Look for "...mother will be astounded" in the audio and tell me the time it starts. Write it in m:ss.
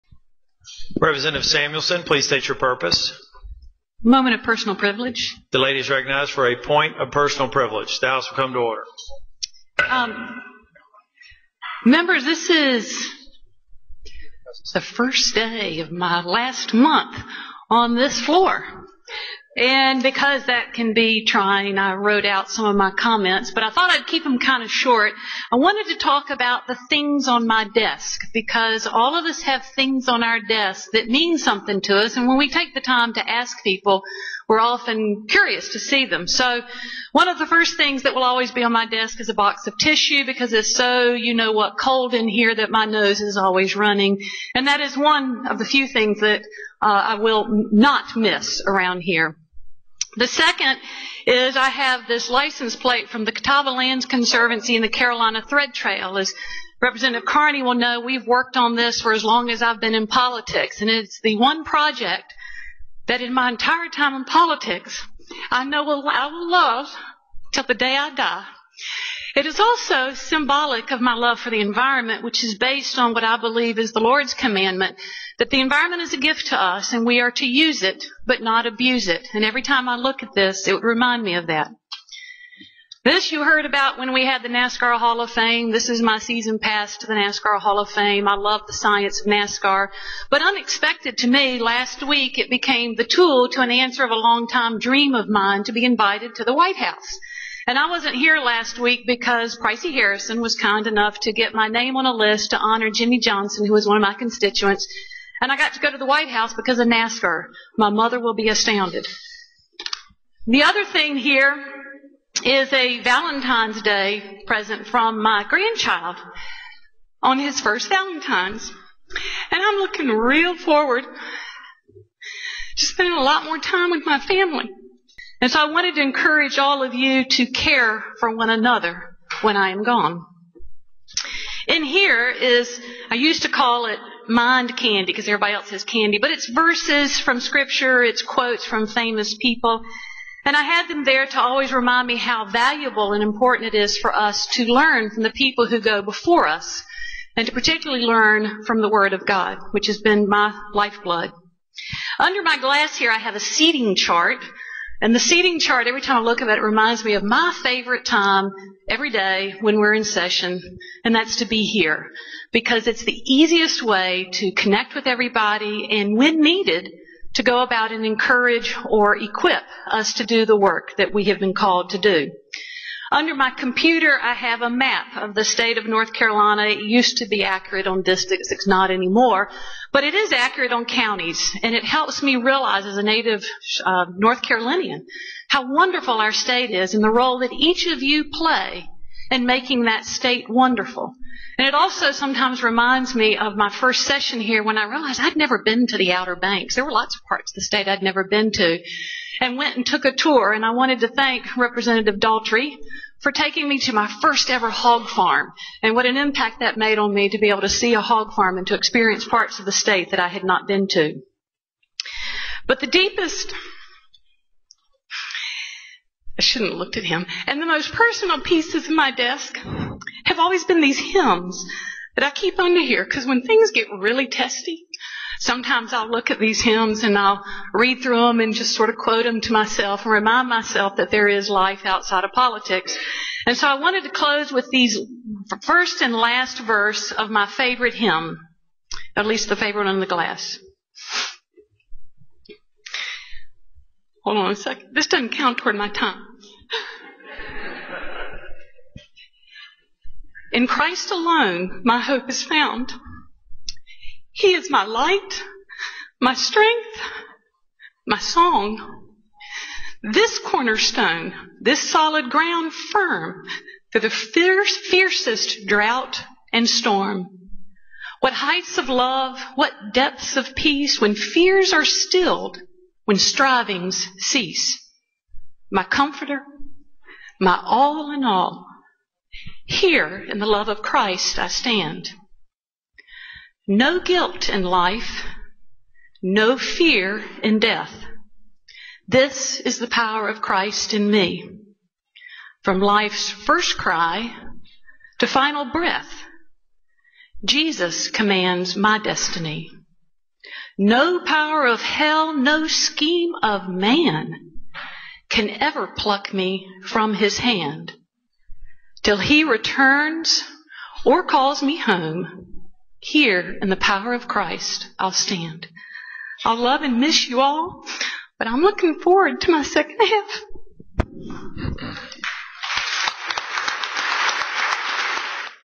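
1:47.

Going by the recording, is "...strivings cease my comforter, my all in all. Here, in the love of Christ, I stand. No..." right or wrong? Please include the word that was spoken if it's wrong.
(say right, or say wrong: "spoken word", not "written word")
right.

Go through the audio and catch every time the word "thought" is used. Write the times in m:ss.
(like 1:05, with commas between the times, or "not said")
0:23.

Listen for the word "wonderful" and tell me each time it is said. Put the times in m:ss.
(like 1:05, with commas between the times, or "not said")
3:05, 3:10.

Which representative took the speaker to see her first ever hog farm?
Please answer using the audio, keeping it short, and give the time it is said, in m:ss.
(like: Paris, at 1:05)
Representative Daltrey, at 3:21.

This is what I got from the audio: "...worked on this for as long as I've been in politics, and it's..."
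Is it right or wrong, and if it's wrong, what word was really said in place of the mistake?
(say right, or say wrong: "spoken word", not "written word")
right.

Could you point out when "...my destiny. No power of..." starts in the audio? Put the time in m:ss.
4:58.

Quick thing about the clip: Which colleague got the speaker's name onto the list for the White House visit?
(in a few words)
Pricey Harrison.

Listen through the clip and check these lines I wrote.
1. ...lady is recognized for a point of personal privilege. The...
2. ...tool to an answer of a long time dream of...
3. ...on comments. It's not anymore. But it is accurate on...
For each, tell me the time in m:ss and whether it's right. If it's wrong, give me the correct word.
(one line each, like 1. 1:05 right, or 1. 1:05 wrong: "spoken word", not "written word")
1. 0:05 right
2. 1:33 right
3. 2:57 wrong: "districts", not "comments".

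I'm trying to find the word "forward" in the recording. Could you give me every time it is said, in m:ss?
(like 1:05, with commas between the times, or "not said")
2:00, 5:18.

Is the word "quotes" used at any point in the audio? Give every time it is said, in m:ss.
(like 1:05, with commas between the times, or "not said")
2:18, 3:48.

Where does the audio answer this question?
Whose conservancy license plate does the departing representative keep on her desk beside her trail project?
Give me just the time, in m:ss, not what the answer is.
0:53.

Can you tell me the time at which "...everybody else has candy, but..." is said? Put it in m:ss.
2:15.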